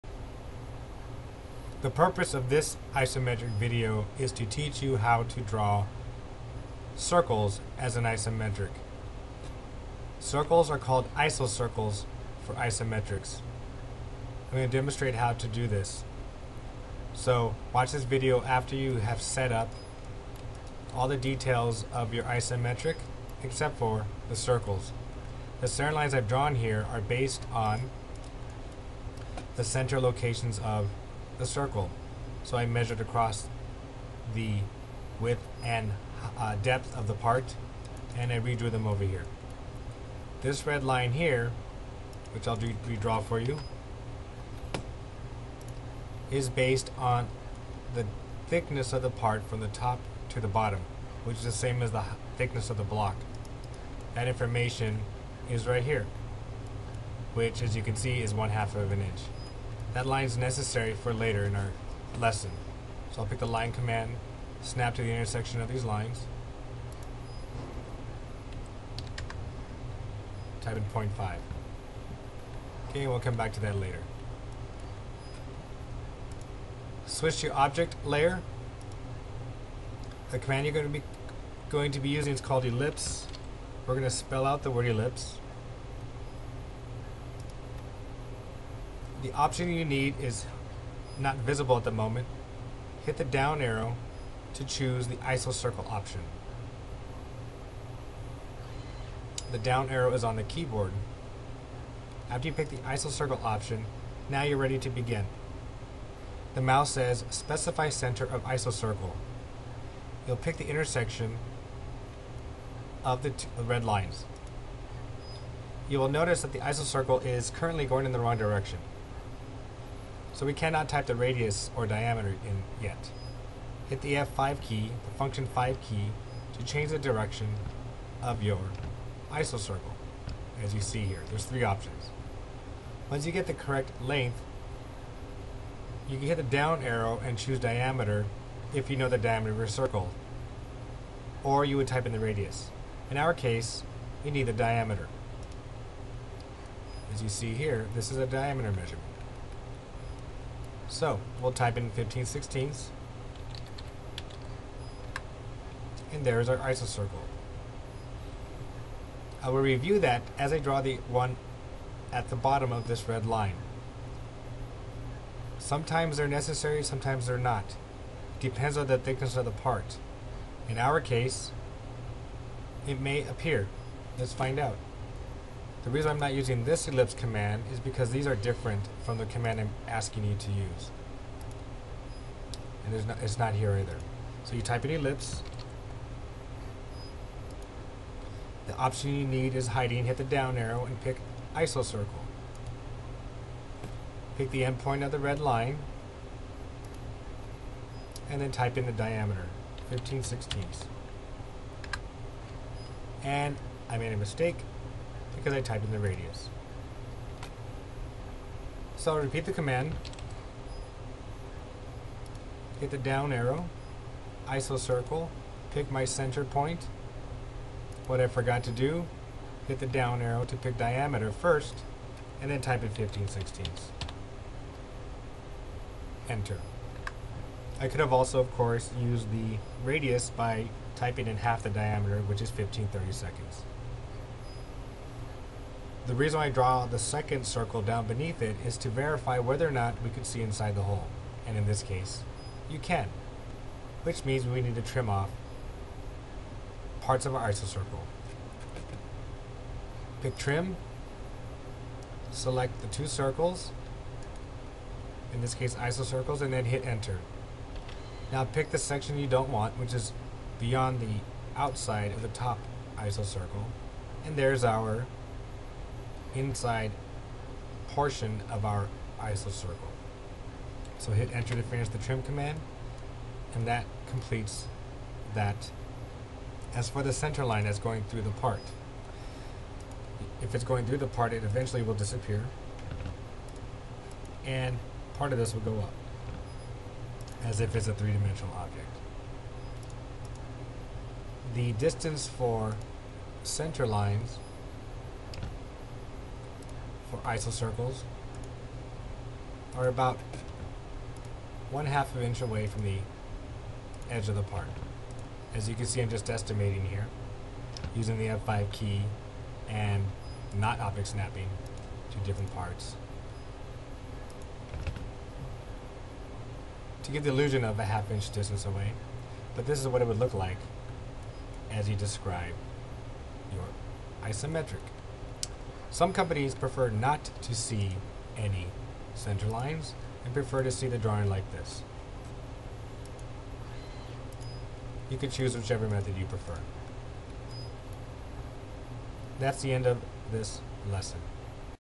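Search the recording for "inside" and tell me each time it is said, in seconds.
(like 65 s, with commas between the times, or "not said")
240 s, 266 s.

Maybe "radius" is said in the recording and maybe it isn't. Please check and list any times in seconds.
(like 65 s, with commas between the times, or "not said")
121 s, 142 s, 205 s, 229 s.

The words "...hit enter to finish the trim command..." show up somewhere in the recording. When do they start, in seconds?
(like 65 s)
271 s.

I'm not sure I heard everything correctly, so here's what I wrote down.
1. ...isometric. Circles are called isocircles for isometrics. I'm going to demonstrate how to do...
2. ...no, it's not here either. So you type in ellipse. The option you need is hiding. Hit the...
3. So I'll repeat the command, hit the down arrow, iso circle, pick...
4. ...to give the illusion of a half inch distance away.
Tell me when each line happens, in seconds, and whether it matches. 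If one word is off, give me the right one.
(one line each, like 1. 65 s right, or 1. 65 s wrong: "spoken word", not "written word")
1. 8 s right
2. 183 s right
3. 208 s right
4. 317 s right.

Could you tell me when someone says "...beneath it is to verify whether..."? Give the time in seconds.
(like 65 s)
238 s.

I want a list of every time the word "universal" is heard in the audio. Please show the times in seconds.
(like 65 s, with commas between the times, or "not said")
not said.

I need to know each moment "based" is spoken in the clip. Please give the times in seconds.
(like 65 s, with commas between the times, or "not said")
27 s, 46 s.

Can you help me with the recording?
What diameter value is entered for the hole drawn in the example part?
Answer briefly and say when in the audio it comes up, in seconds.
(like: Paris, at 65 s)
15/16, at 151 s.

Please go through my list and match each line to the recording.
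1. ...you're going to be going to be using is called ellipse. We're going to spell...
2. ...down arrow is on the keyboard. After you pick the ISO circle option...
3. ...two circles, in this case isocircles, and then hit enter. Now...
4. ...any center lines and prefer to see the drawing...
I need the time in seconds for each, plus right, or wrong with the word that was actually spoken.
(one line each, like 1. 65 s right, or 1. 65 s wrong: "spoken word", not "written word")
1. 80 s right
2. 99 s right
3. 252 s right
4. 328 s right.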